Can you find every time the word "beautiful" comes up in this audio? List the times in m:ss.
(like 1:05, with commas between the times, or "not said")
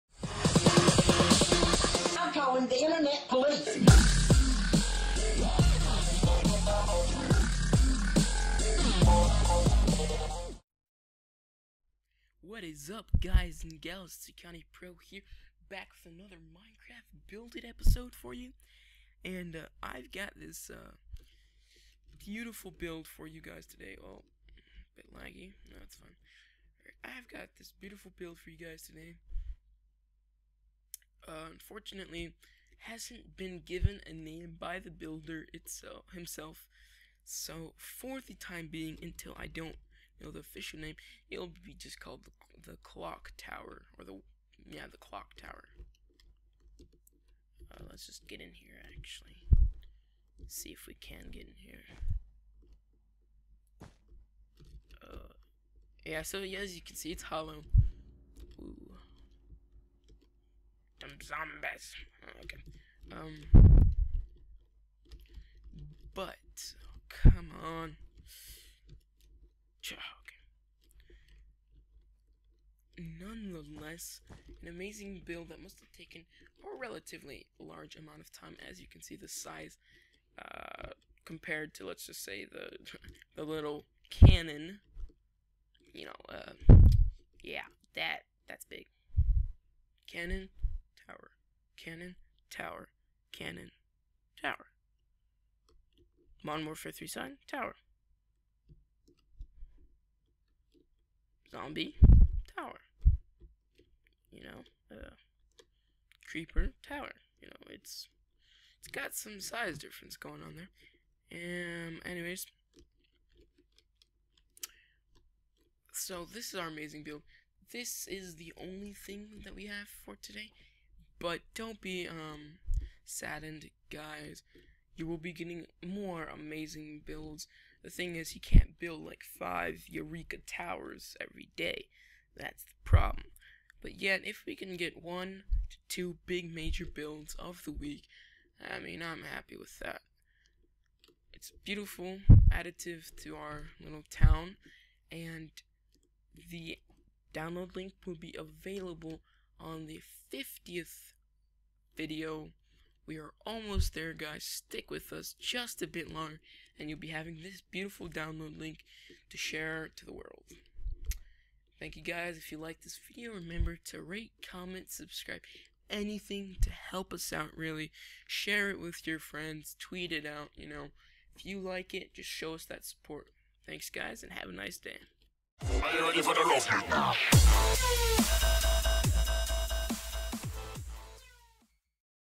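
0:22, 0:27, 2:21, 2:37.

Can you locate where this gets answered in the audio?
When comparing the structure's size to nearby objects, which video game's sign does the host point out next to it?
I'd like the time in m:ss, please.
1:36.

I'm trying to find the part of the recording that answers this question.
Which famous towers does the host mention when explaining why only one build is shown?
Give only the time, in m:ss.
2:09.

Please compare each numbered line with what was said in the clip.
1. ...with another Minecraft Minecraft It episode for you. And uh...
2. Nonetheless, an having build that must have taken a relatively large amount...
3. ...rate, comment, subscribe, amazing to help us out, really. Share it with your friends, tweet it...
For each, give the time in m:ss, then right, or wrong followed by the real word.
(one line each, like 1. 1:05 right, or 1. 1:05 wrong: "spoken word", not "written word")
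1. 0:16 wrong: "Build", not "Minecraft"
2. 1:13 wrong: "amazing", not "having"
3. 2:44 wrong: "anything", not "amazing".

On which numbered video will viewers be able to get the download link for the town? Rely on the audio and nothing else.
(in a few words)
50th.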